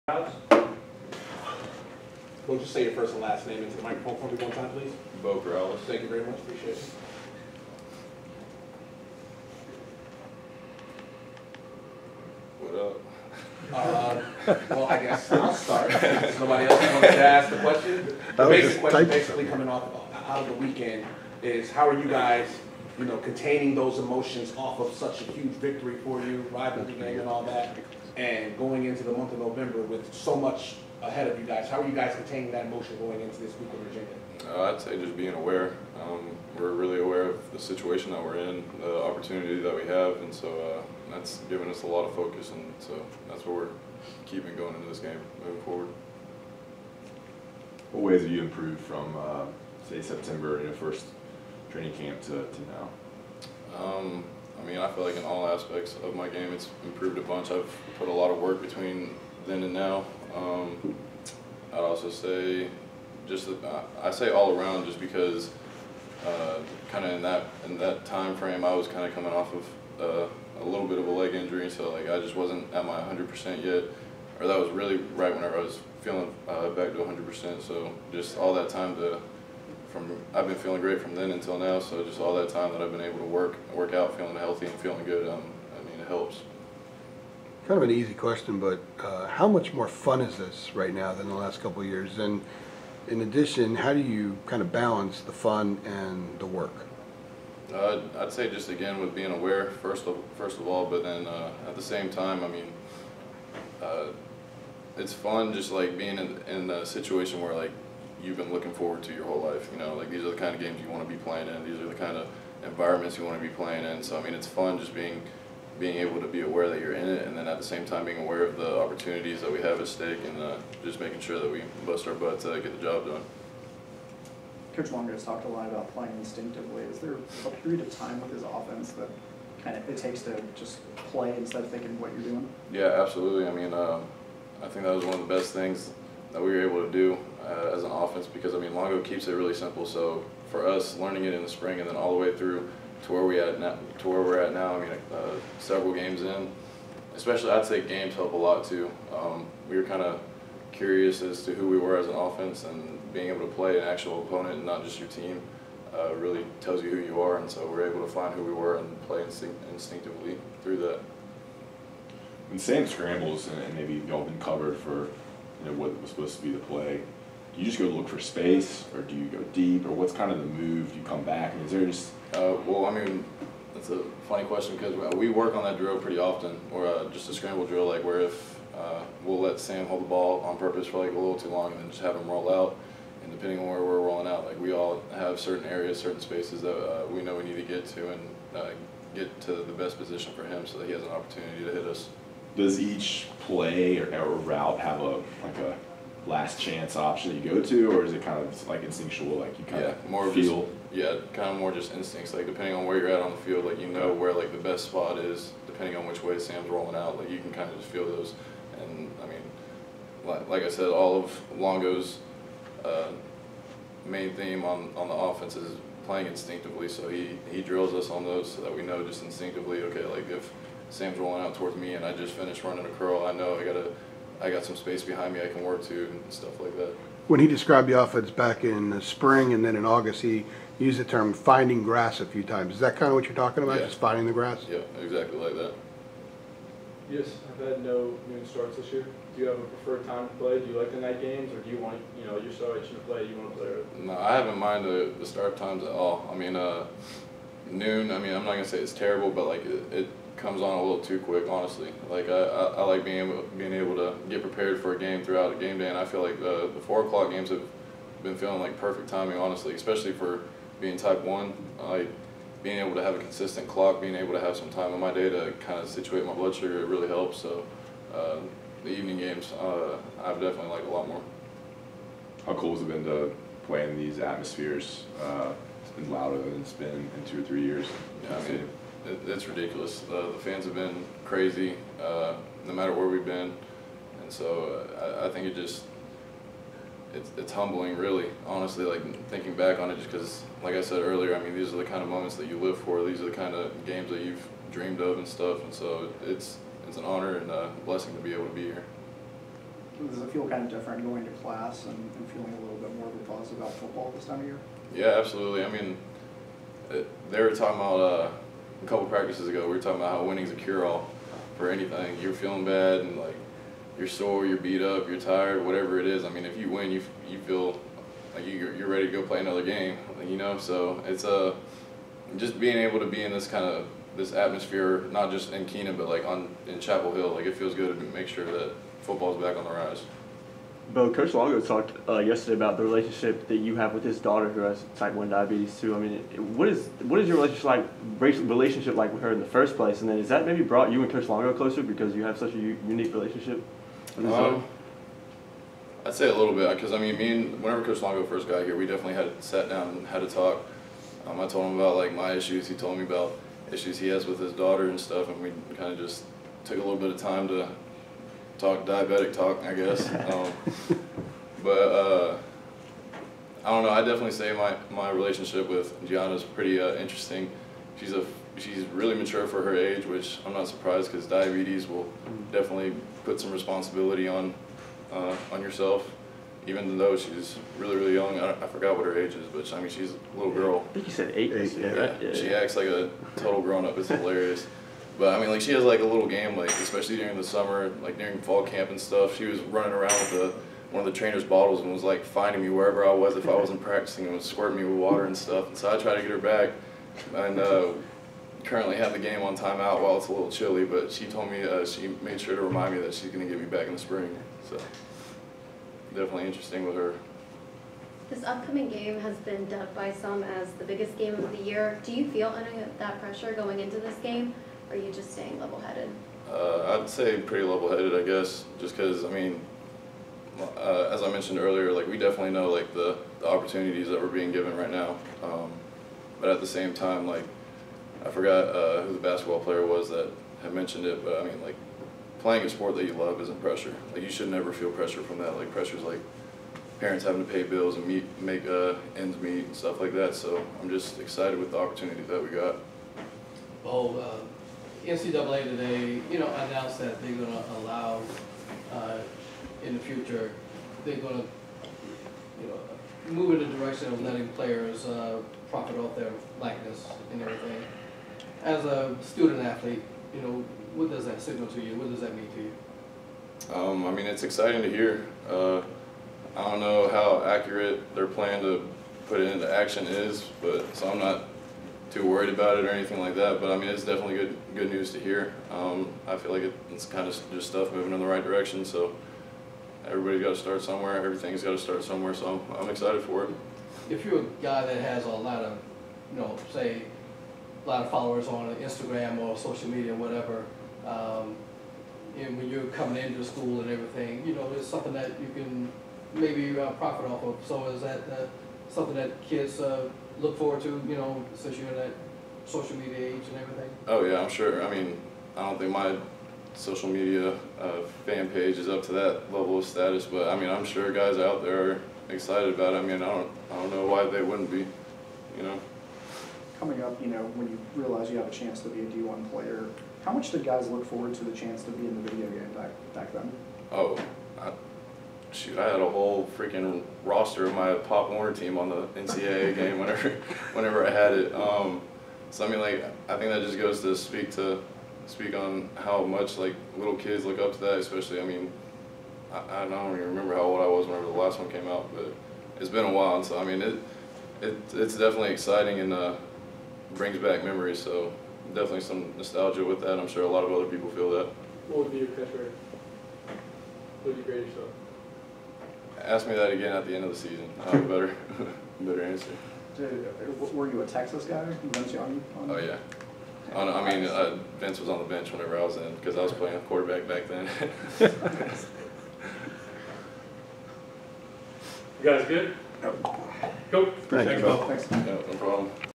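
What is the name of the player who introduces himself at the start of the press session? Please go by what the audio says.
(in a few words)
Beau Corrales.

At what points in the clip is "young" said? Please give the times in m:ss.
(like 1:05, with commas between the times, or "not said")
6:18, 9:22.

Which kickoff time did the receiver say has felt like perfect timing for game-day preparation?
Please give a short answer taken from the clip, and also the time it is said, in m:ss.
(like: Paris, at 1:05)
four o'clock, at 4:16.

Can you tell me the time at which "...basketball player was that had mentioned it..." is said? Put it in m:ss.
7:09.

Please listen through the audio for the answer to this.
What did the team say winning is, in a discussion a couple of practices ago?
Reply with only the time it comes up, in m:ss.
5:10.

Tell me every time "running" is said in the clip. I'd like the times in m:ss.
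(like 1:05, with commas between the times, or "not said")
3:42, 6:29.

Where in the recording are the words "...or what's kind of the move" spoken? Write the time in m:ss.
2:49.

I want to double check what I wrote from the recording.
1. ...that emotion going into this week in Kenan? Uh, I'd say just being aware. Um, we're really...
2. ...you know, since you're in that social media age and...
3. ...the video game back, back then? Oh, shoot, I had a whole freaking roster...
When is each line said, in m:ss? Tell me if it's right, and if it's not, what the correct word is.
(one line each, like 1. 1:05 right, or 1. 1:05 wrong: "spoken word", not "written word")
1. 0:32 wrong: "Virginia", not "Kenan"
2. 8:21 right
3. 8:42 right.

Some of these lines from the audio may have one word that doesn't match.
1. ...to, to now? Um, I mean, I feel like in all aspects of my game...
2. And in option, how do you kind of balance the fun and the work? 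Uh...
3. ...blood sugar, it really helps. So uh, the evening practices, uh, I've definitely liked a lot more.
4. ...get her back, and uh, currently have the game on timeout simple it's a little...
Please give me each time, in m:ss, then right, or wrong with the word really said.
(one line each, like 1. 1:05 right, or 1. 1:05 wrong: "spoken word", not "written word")
1. 0:52 right
2. 1:32 wrong: "addition", not "option"
3. 4:26 wrong: "games", not "practices"
4. 6:36 wrong: "while", not "simple".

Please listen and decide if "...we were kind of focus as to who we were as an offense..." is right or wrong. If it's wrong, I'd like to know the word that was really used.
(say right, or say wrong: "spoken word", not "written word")
wrong: "curious", not "focus".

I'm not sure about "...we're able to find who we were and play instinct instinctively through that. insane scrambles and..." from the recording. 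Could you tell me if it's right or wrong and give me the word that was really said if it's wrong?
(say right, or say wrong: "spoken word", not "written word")
right.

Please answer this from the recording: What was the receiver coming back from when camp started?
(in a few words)
leg injury.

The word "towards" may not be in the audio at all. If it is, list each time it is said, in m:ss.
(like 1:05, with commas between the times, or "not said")
3:41.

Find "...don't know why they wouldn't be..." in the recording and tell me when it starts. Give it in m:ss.
8:33.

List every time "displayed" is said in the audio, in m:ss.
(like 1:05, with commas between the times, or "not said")
not said.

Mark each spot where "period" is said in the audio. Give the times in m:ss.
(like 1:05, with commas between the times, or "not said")
2:07.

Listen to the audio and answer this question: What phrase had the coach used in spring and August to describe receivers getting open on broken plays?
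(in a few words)
finding grass.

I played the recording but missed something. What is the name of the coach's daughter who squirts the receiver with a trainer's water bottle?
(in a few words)
Gianna.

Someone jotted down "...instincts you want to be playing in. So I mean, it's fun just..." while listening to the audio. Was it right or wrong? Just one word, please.
wrong.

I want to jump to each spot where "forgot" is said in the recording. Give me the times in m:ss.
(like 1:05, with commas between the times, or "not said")
6:18, 7:08.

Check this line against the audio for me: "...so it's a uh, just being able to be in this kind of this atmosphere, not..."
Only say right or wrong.
right.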